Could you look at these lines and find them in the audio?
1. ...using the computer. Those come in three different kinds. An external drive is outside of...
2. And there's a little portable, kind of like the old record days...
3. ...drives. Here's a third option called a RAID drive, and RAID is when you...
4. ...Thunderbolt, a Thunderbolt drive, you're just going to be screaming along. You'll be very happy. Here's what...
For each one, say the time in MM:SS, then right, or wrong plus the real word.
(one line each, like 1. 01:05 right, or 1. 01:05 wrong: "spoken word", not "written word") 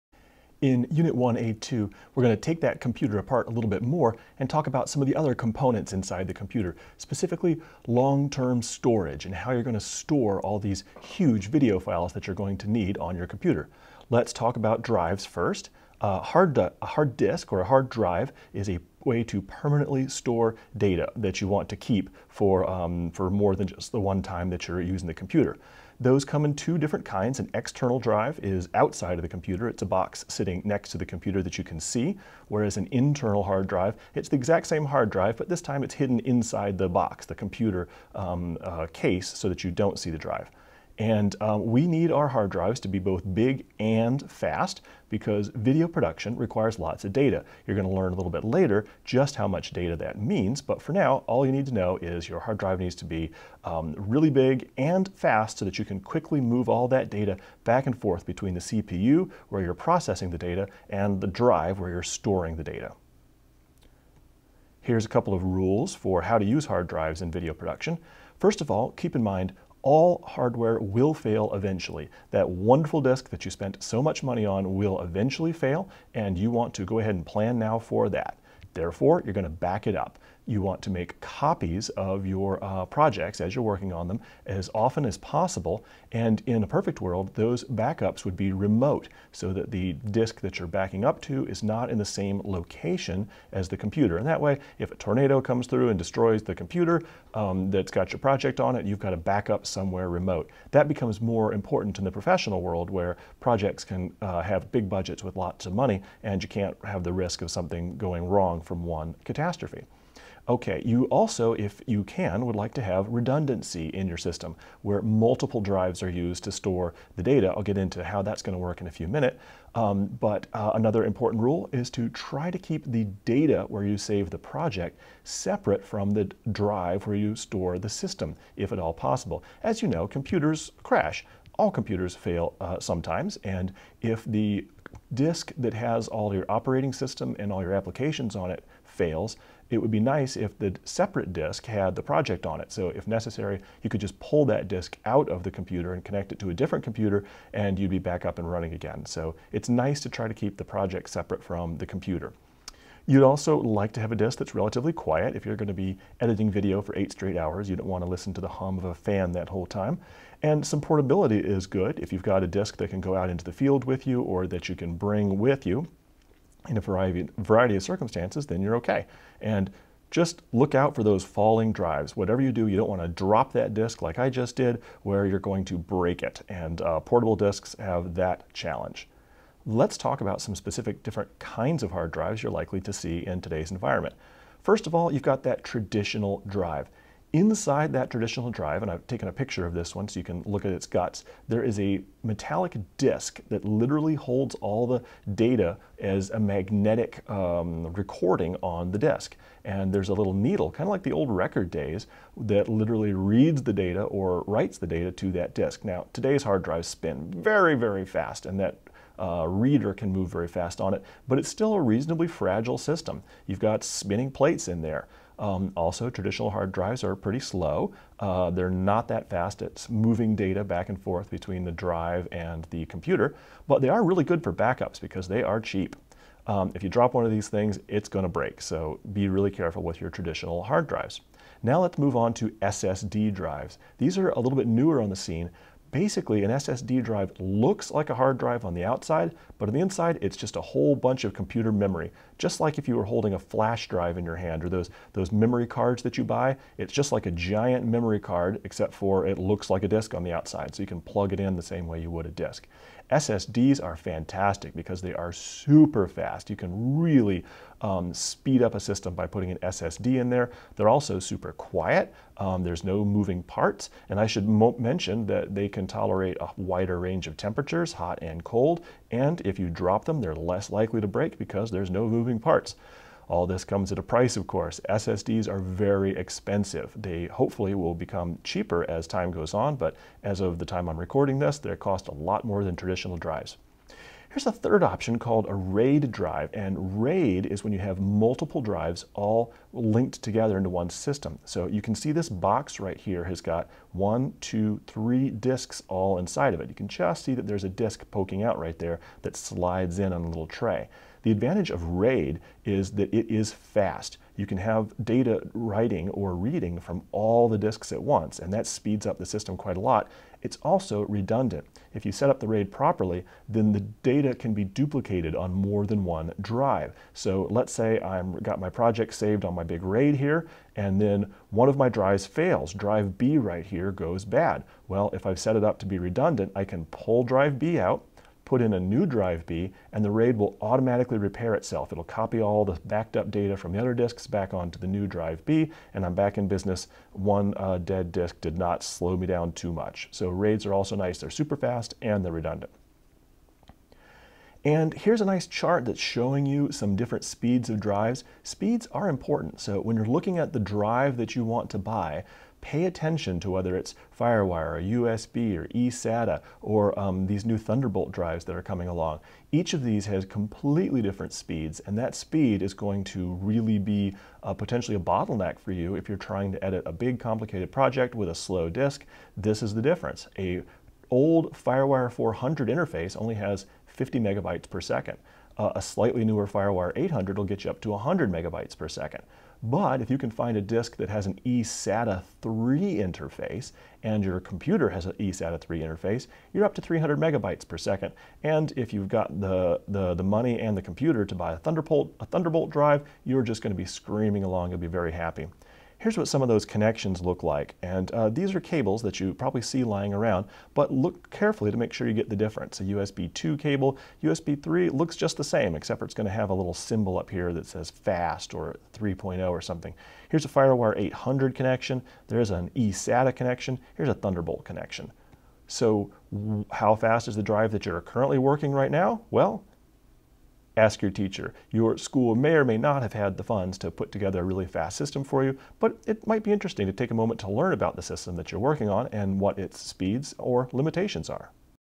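1. 00:24 wrong: "two", not "three"
2. 03:19 wrong: "needle", not "portable"
3. 04:43 right
4. 06:31 right.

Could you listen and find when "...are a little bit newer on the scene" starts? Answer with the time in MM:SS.
03:54.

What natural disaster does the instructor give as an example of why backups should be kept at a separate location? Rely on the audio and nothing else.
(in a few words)
A tornado.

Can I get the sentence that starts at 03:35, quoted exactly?
Um, also, traditional hard drives are pretty slow.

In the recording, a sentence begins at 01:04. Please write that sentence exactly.
Here's a couple of rules for how to use hard drives in video production.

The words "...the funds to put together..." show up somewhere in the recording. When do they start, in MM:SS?
07:03.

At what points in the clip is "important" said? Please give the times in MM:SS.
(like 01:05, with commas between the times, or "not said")
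01:41, 02:01, 05:49.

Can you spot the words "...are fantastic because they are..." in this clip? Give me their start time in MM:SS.
04:13.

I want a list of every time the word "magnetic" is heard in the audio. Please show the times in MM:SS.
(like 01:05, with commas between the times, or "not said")
03:16.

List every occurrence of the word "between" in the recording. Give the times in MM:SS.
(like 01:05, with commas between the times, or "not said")
00:58, 03:41.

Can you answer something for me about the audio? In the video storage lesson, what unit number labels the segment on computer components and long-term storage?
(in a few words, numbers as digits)
1A2.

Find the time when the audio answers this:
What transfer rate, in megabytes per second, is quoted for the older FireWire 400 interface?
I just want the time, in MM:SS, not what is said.
06:14.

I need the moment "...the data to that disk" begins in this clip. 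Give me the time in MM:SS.
03:24.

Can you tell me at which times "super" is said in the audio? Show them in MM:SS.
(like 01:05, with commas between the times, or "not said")
04:15, 04:21, 05:41.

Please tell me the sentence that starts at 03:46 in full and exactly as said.
Um, if you drop one of these things, it's going to break, so be really careful with your traditional hard drives.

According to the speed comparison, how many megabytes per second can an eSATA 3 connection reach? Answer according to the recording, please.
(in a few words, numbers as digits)
300.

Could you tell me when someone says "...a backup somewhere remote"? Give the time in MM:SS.
01:39.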